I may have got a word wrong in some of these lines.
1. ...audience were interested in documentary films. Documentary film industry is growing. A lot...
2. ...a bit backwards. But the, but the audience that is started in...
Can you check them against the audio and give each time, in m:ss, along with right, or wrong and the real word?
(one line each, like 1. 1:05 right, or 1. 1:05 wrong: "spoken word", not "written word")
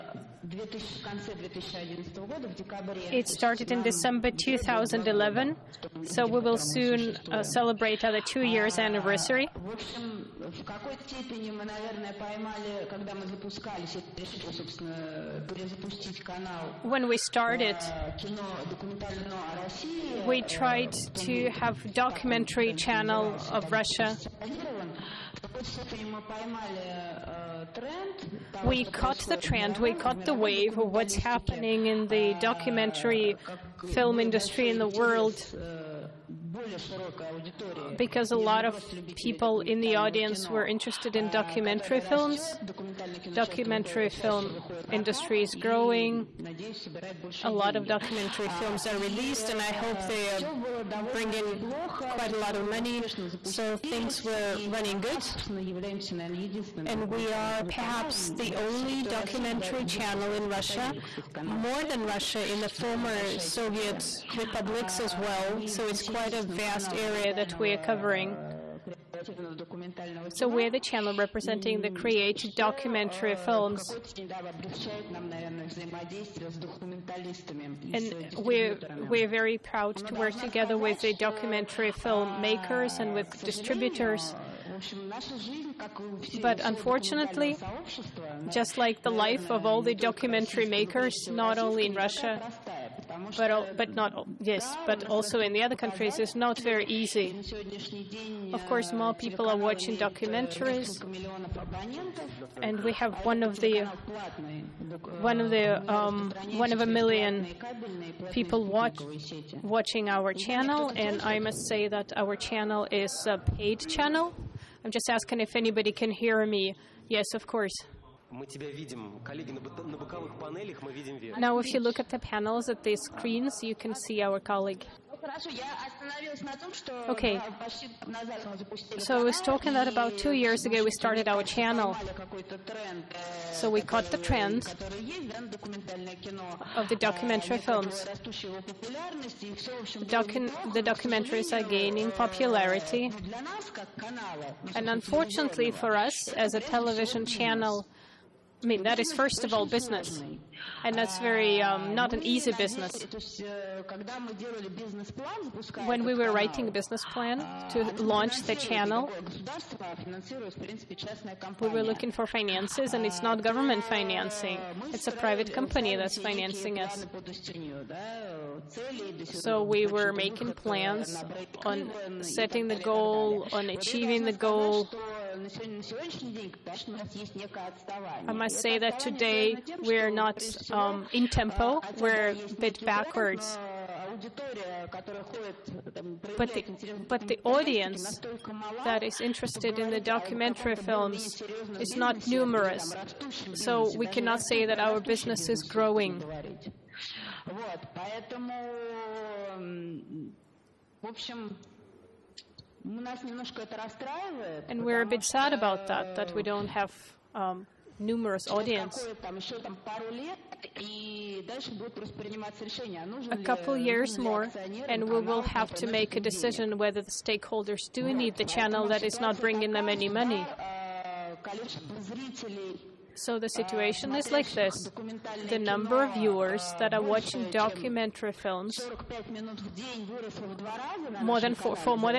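1. 0:39 right
2. 3:02 wrong: "interested", not "started".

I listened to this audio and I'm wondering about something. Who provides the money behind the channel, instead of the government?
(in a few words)
private company.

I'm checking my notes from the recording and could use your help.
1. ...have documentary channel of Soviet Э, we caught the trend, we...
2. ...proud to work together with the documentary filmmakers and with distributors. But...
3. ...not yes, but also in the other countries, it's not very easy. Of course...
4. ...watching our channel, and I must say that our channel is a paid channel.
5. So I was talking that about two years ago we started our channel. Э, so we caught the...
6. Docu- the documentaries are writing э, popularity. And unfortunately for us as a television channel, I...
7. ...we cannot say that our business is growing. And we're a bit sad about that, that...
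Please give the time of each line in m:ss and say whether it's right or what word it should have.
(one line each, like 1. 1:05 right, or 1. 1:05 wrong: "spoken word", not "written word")
1. 0:21 wrong: "Russia", not "Soviet"
2. 1:19 right
3. 1:33 right
4. 1:49 right
5. 2:08 right
6. 2:20 wrong: "gaining", not "writing"
7. 3:13 right.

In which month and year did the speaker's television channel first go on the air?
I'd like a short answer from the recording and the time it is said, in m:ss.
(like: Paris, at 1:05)
December 2011, at 0:03.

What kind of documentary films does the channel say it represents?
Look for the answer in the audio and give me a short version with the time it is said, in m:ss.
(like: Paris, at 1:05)
creative documentary films, at 1:11.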